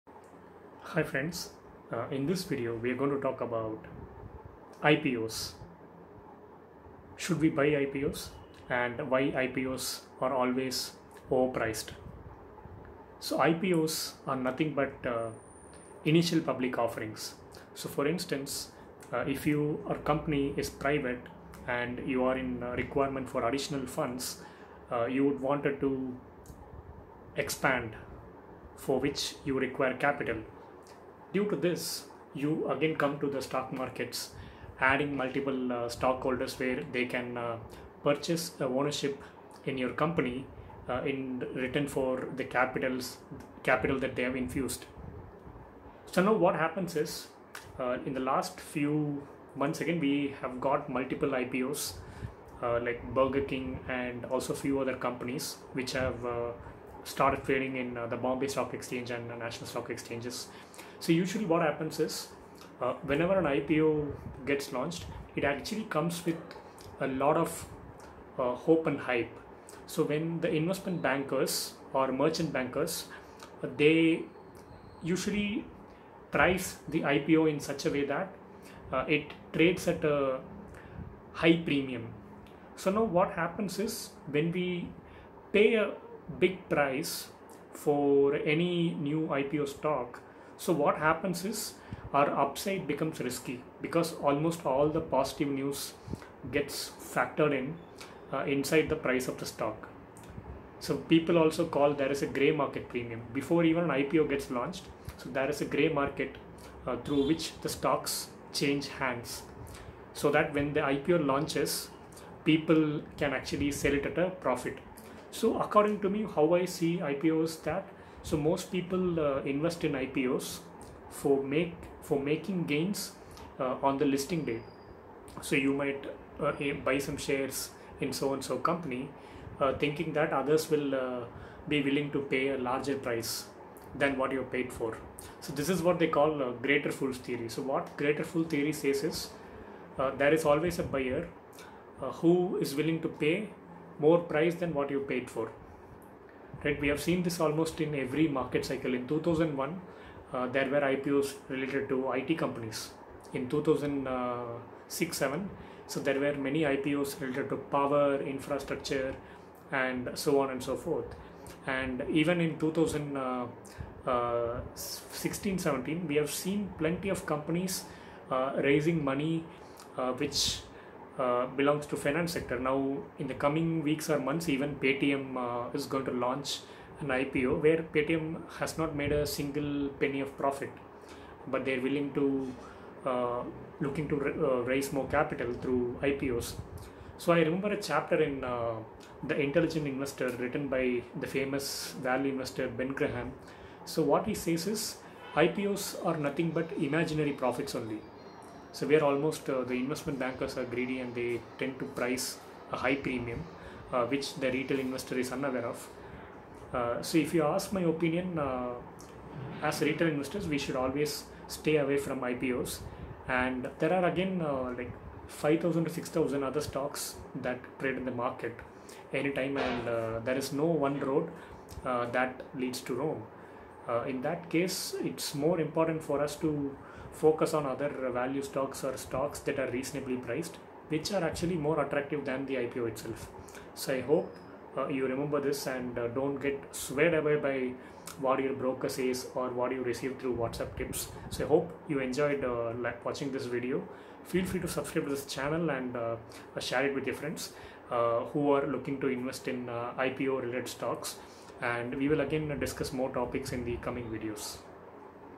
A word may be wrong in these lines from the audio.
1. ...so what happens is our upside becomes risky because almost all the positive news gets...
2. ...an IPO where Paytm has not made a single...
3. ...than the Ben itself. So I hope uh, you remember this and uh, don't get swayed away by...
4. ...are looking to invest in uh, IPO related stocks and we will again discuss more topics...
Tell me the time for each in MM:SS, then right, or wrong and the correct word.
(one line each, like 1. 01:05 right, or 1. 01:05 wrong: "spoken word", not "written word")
1. 01:30 right
2. 02:57 right
3. 03:52 wrong: "IPO", not "Ben"
4. 04:08 right.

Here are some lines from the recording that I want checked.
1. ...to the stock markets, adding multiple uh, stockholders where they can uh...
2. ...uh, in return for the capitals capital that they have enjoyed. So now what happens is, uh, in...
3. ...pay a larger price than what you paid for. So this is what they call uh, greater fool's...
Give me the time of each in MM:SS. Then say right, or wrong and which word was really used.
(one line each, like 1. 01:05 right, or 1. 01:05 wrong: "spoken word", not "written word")
1. 00:33 right
2. 00:40 wrong: "infused", not "enjoyed"
3. 02:12 right.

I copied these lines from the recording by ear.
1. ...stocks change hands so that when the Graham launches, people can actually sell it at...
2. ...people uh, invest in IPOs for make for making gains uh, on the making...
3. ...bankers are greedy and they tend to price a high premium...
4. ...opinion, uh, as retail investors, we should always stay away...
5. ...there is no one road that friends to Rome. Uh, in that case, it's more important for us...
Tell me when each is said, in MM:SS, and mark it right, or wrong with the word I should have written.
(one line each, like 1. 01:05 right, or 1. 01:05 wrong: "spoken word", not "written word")
1. 01:47 wrong: "IPO", not "Graham"
2. 01:58 wrong: "listing", not "making"
3. 03:20 right
4. 03:27 right
5. 03:40 wrong: "leads", not "friends".